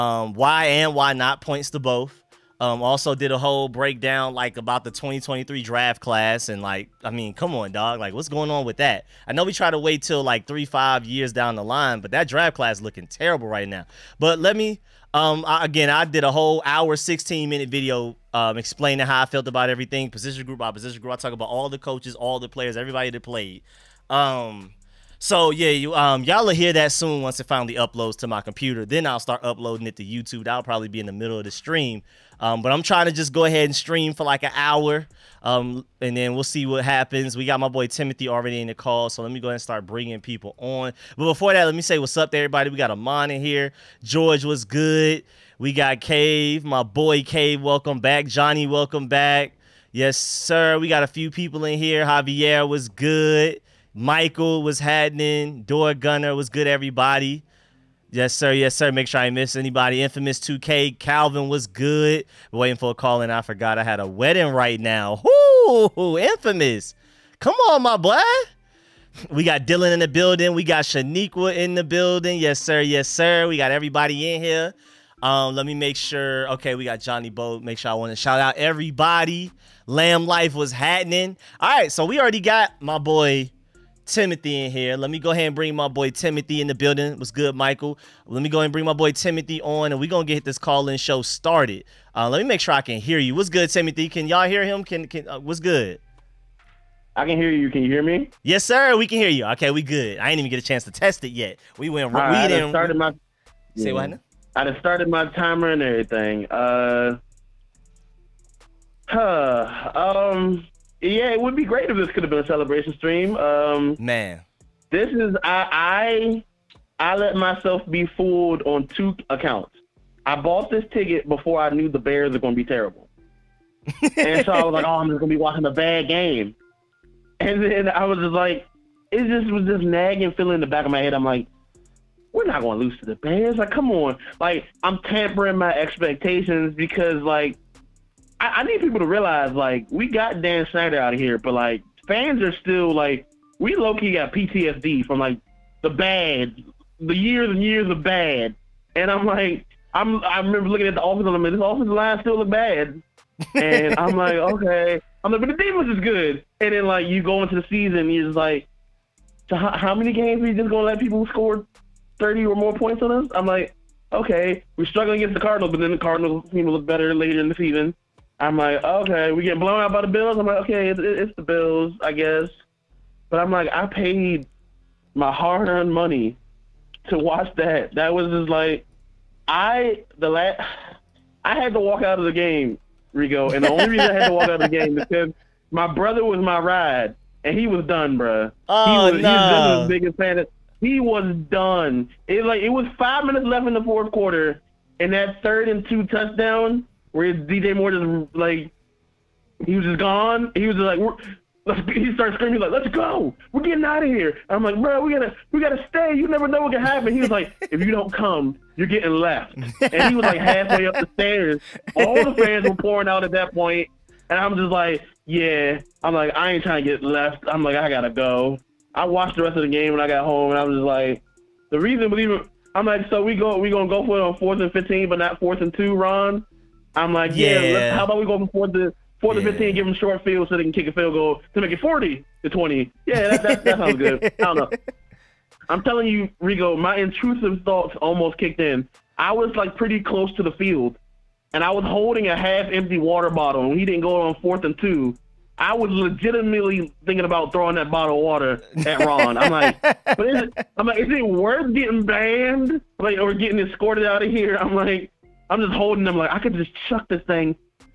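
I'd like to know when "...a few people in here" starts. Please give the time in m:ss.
0:51.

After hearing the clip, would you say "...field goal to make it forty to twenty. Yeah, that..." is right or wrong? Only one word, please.
right.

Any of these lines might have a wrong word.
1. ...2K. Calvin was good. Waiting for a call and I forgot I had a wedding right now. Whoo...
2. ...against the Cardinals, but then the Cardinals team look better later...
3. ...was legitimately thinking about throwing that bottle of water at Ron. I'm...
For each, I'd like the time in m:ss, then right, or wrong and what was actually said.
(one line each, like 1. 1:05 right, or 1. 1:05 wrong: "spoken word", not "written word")
1. 1:00 right
2. 2:45 right
3. 4:05 right.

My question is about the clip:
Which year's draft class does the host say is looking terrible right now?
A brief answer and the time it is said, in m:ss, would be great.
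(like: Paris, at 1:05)
2023, at 0:04.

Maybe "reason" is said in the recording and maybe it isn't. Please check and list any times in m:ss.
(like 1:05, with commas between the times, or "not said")
3:03, 3:41.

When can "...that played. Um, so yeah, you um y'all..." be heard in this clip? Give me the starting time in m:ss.
0:23.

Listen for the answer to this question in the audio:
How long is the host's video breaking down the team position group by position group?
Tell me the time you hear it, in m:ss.
0:16.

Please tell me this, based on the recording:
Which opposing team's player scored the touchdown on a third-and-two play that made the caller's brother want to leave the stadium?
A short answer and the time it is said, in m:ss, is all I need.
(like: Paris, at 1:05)
DJ Moore, at 3:17.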